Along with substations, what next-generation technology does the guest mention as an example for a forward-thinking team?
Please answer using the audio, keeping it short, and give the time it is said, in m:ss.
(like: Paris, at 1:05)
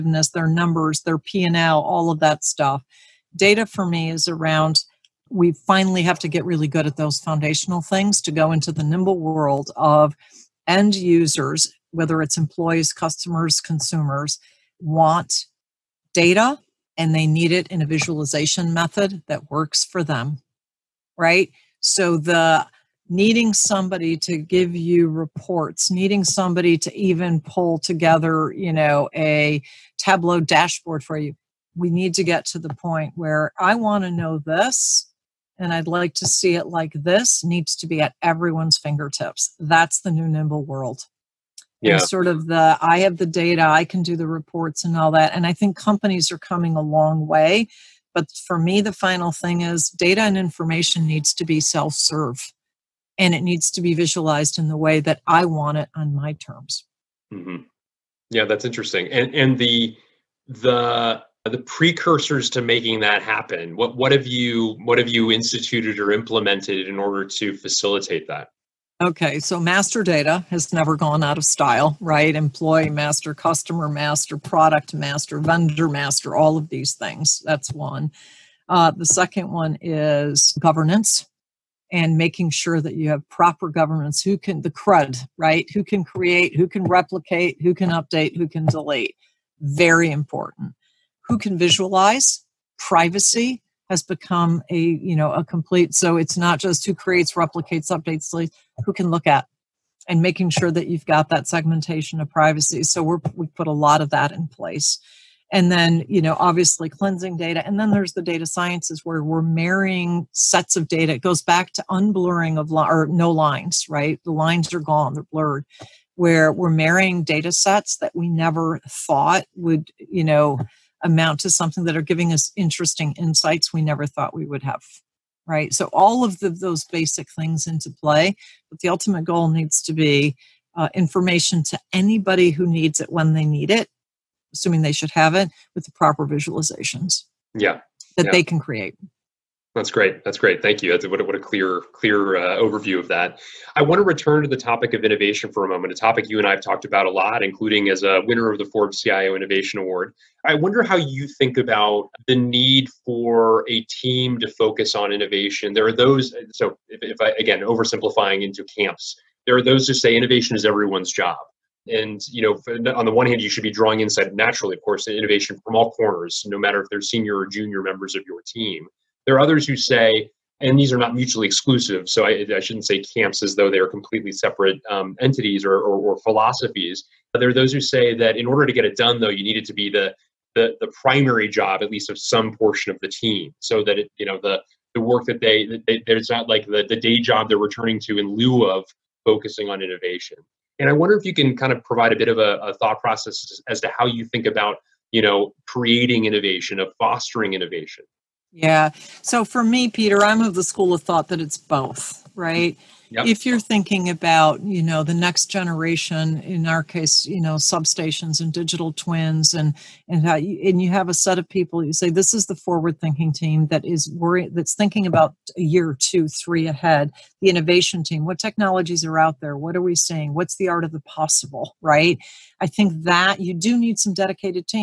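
digital twins, at 3:28.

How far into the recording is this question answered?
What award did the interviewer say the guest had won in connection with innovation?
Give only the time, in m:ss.
2:28.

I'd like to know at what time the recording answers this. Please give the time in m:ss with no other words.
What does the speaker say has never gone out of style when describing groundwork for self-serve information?
1:09.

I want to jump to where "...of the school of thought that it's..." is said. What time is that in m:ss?
3:20.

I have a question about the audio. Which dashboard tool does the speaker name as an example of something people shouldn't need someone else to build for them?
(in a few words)
Tableau.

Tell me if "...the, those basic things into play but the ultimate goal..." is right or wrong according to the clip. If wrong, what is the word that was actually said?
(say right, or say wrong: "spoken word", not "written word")
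right.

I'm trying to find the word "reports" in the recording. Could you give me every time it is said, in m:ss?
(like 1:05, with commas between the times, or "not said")
0:25, 0:44.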